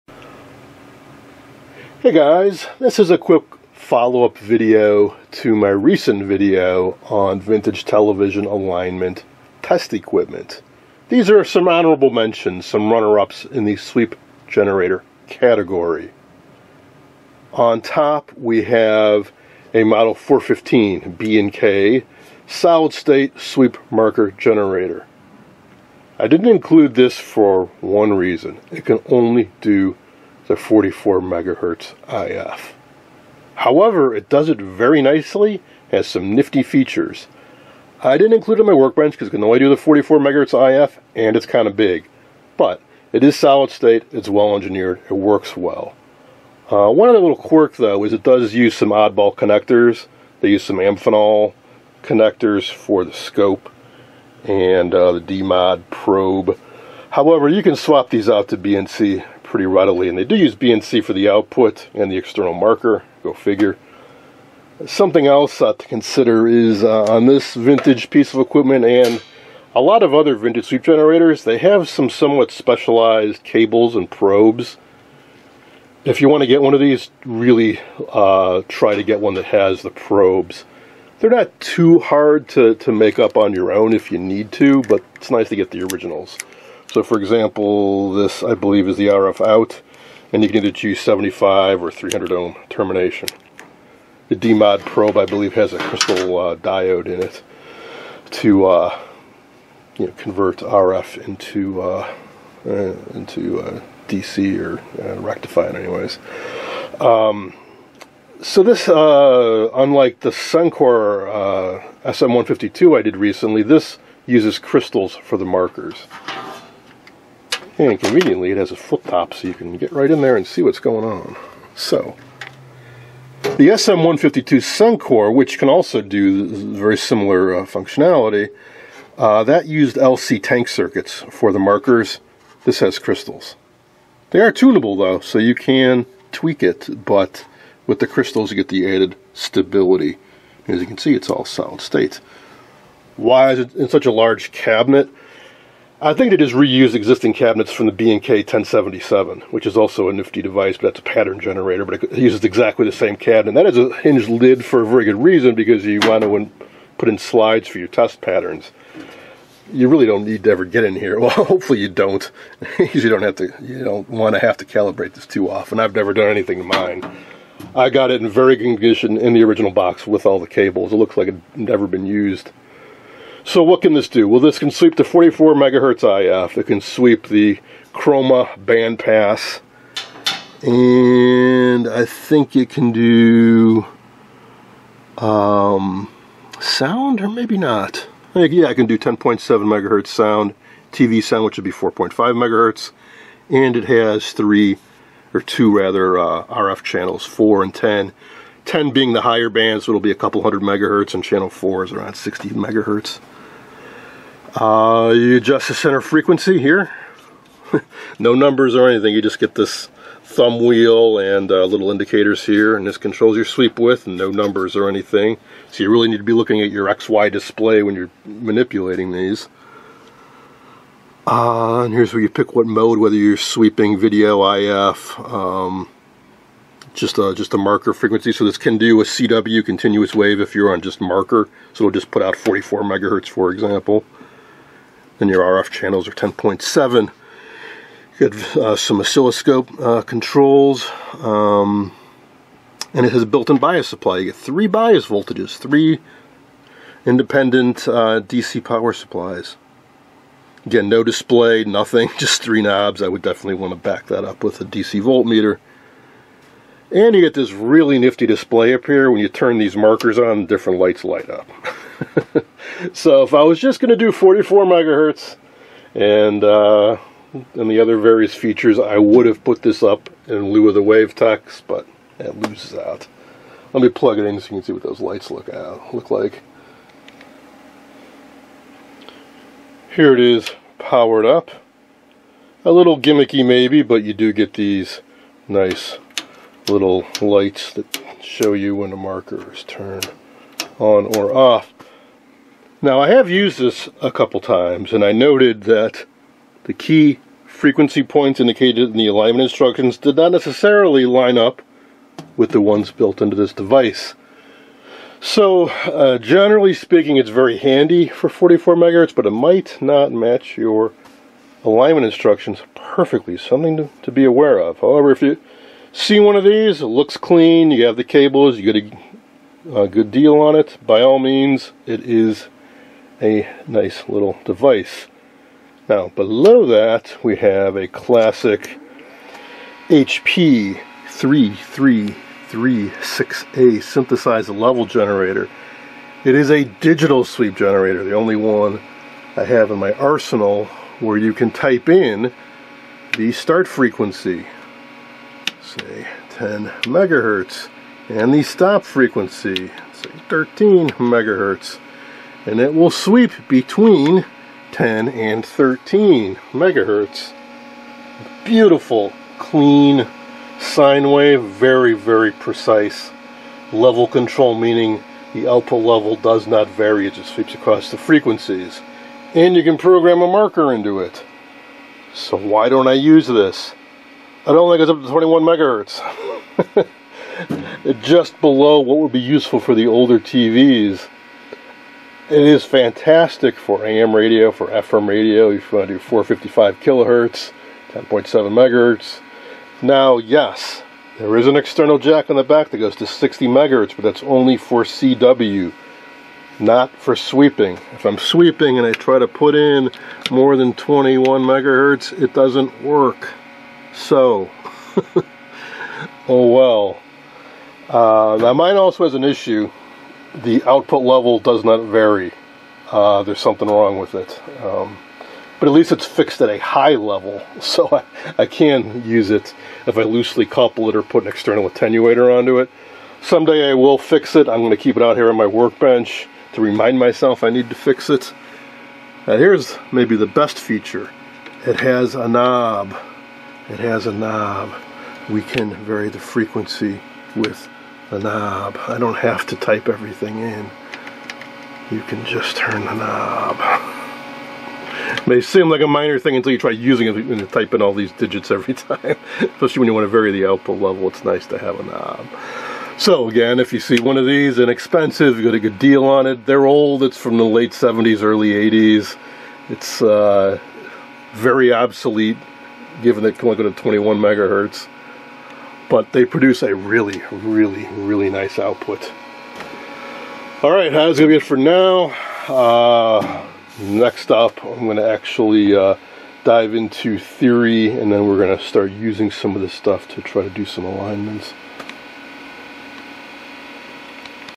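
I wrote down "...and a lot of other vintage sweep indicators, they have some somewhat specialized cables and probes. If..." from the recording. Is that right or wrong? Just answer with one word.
wrong.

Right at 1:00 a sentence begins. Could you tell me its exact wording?
And they do use BNC for the output and the external marker.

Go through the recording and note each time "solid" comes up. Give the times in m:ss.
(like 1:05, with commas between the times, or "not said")
0:22, 0:43, 2:21.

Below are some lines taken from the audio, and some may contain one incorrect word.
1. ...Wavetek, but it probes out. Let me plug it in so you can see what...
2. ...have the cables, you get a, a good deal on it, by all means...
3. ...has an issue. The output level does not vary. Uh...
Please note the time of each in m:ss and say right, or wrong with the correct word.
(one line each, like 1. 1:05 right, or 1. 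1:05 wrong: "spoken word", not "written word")
1. 4:30 wrong: "loses", not "probes"
2. 5:17 right
3. 6:49 right.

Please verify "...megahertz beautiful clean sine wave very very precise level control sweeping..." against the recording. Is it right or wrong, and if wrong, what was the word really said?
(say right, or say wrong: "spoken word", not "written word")
wrong: "meaning", not "sweeping".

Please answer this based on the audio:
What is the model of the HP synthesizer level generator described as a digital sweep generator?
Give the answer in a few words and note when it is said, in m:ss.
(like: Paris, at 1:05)
HP 3336A, at 5:29.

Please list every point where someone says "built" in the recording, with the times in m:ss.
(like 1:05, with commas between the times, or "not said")
4:03, 5:02.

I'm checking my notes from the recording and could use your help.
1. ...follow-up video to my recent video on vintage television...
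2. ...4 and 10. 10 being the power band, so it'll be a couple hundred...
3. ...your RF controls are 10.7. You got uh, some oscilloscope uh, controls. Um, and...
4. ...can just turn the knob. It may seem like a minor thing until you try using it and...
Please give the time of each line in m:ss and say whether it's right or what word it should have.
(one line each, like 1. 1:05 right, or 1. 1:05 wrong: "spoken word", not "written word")
1. 0:03 right
2. 3:17 wrong: "higher", not "power"
3. 3:55 wrong: "channels", not "controls"
4. 7:22 right.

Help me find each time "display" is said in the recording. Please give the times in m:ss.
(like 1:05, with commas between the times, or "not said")
3:37, 4:11, 4:18.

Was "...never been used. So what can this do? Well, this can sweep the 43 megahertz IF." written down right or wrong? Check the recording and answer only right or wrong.
wrong.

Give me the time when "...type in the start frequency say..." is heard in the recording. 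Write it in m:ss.
5:41.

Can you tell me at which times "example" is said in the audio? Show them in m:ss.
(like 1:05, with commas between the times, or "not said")
1:27, 3:53.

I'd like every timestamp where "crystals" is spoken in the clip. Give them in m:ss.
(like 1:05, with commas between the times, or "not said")
1:35, 1:54, 2:12, 2:18.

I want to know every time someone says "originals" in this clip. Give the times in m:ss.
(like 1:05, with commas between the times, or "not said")
1:25, 2:49.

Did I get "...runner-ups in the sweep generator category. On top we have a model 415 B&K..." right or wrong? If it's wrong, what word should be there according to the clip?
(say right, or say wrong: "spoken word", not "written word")
right.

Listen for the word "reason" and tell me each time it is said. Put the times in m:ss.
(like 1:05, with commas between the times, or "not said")
0:28, 2:35.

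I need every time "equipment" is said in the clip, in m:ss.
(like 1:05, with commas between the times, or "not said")
0:09, 1:08.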